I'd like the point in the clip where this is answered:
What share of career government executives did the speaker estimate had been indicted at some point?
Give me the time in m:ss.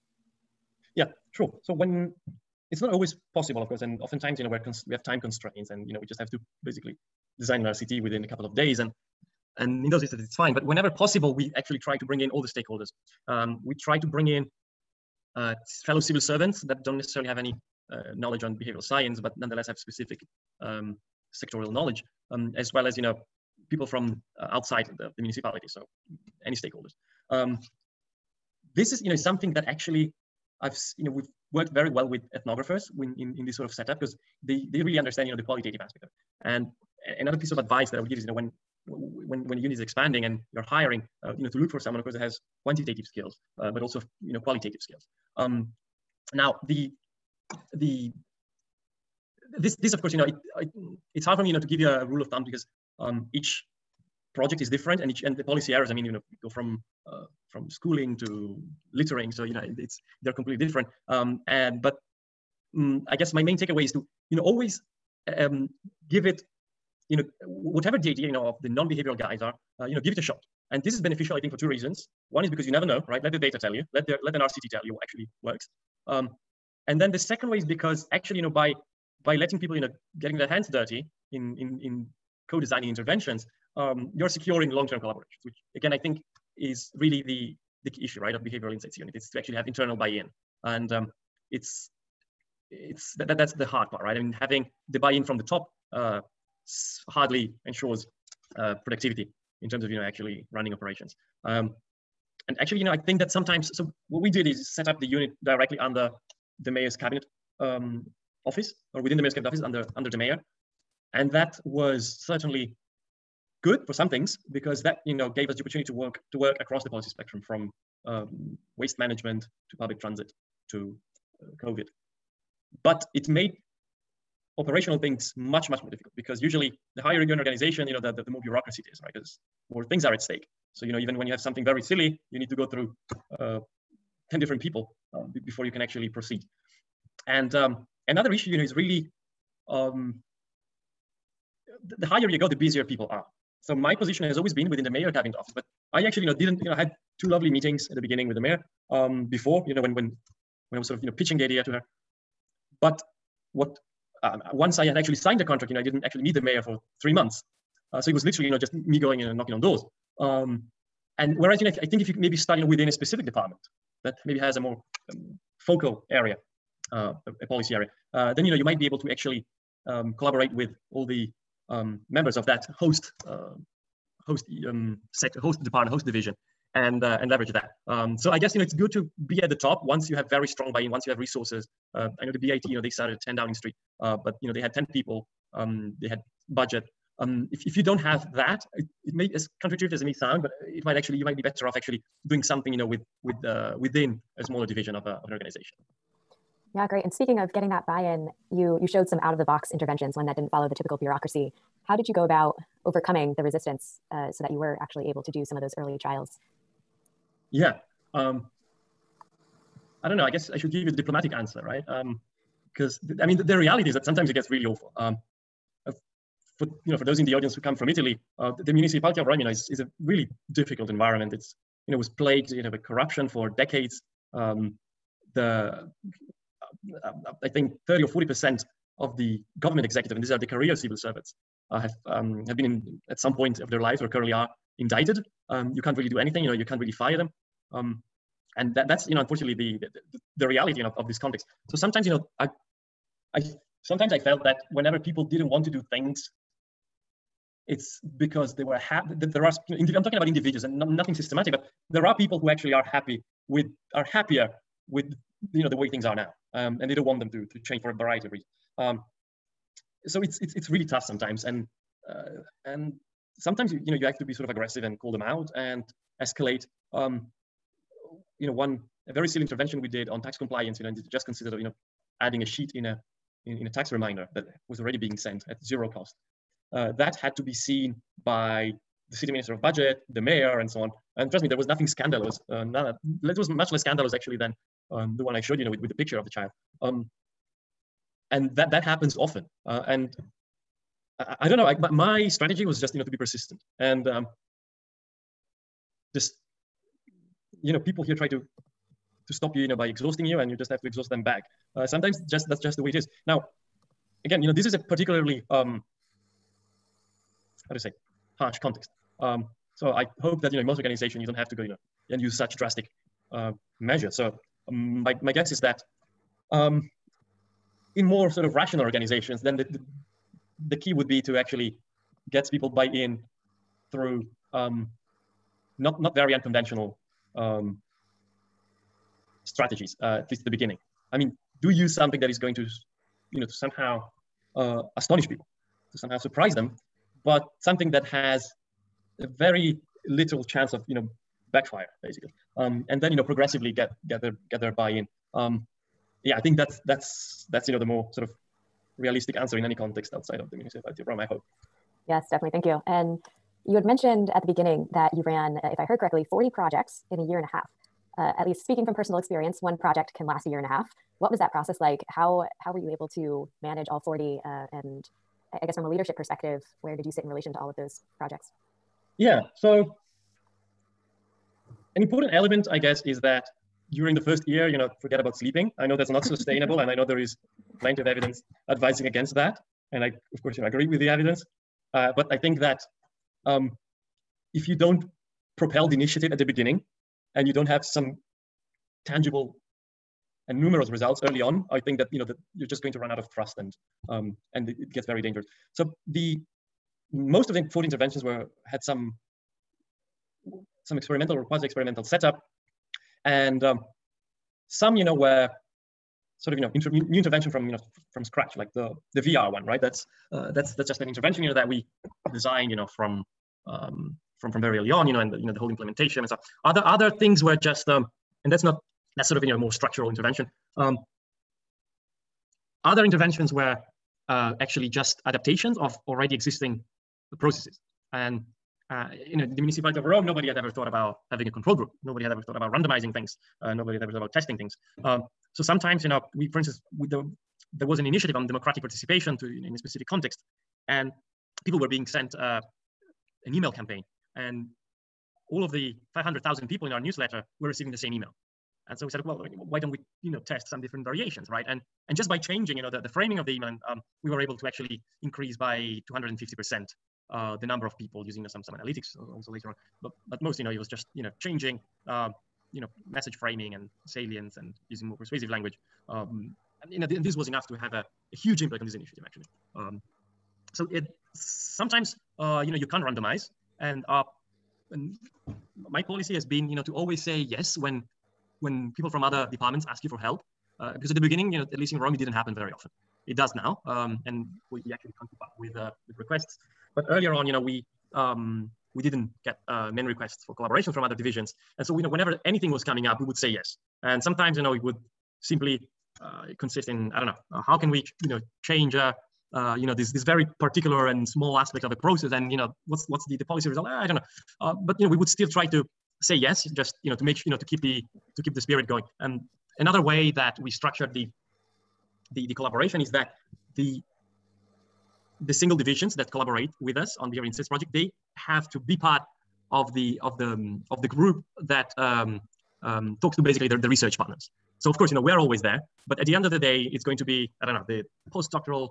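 3:47.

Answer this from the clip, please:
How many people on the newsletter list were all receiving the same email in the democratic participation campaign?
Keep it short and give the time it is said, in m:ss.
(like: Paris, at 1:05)
500,000, at 7:26.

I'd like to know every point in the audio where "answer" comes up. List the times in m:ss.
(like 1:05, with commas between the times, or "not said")
3:31, 5:49.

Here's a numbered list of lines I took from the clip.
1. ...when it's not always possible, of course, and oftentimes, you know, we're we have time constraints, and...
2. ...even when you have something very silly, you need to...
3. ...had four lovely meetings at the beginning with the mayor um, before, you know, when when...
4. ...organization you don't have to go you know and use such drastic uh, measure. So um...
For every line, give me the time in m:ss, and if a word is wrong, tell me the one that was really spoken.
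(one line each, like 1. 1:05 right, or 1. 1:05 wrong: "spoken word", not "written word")
1. 0:01 right
2. 2:10 right
3. 2:26 wrong: "two", not "four"
4. 5:10 right.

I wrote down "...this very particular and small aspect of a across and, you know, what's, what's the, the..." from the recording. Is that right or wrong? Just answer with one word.
wrong.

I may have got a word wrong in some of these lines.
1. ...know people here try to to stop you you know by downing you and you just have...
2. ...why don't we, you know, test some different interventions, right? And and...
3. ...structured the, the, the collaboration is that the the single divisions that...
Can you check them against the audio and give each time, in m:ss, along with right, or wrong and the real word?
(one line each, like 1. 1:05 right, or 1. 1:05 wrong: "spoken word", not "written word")
1. 4:57 wrong: "exhausting", not "downing"
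2. 7:29 wrong: "variations", not "interventions"
3. 8:30 right.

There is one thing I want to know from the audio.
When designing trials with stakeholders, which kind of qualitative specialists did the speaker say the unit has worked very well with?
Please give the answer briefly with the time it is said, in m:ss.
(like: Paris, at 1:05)
Ethnographers, at 0:32.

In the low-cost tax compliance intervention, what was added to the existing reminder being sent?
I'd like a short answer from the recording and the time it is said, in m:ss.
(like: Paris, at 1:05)
A sheet, at 4:32.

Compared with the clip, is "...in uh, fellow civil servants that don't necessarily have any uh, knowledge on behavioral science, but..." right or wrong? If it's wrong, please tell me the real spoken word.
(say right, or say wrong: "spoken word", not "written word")
right.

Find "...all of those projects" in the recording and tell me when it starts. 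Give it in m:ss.
6:07.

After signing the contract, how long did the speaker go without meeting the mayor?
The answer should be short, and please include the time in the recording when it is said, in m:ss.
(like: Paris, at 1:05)
3 months, at 2:37.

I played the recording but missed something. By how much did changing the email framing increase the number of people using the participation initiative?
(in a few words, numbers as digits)
250%.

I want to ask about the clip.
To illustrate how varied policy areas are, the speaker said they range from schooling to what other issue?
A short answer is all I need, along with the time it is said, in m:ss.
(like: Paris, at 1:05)
Littering, at 0:58.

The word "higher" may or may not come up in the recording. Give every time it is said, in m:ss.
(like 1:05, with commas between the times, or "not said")
2:07, 2:22.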